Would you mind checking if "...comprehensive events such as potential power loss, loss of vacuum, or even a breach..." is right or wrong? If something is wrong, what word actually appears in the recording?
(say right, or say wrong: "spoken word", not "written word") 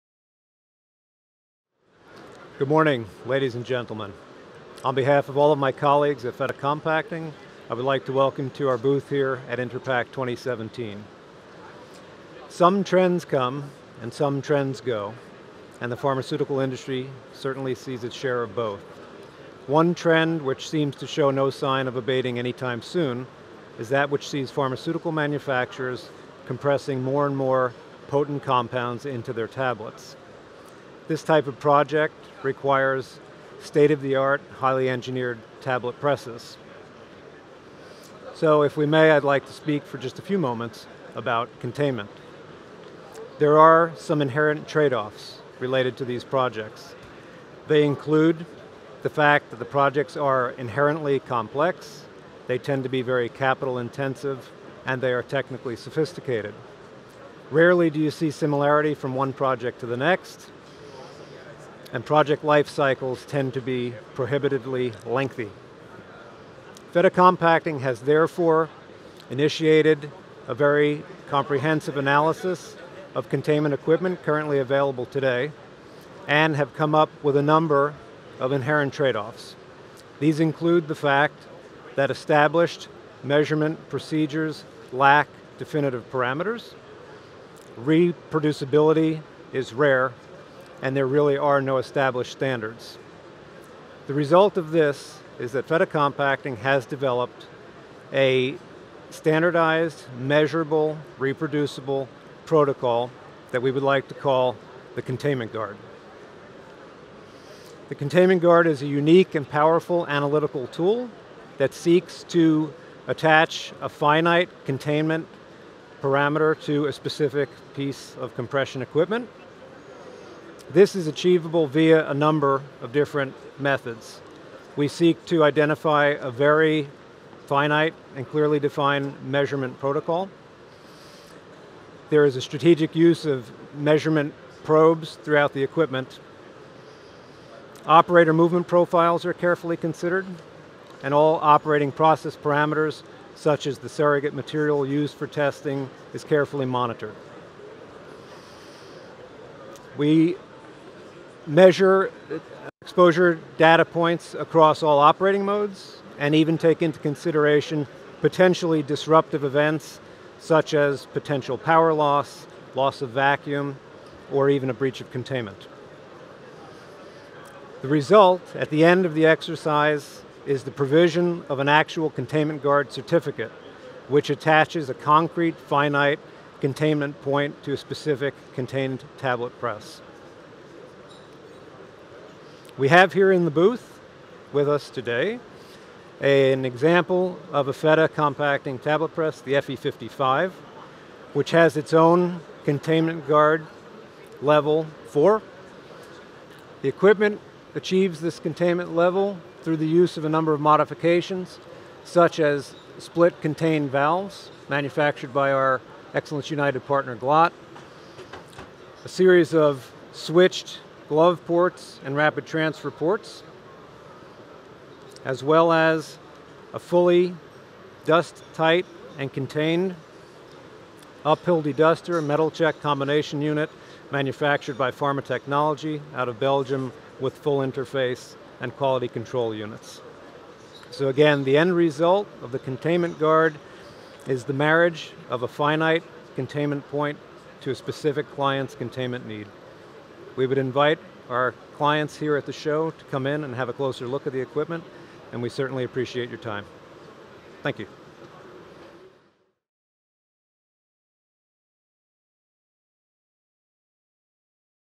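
wrong: "disruptive", not "comprehensive".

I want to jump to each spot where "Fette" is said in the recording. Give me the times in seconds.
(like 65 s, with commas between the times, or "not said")
6 s, 66 s, 95 s, 187 s.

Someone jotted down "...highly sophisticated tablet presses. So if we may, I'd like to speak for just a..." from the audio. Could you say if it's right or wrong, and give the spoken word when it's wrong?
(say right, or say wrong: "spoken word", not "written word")
wrong: "engineered", not "sophisticated".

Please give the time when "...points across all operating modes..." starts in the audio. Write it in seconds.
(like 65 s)
153 s.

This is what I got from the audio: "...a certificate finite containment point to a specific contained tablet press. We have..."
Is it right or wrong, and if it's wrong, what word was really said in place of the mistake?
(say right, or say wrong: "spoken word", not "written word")
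wrong: "concrete", not "certificate".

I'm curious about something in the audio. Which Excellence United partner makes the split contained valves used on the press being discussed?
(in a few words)
Glatt.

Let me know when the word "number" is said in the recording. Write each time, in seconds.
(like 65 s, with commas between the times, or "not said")
77 s, 122 s, 200 s.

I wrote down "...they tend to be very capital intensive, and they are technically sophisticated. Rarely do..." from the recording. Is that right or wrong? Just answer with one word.
right.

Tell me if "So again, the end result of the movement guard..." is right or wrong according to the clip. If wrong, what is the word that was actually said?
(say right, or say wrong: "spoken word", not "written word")
wrong: "containment", not "movement".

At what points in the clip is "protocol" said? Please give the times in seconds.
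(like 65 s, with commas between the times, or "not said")
102 s, 129 s.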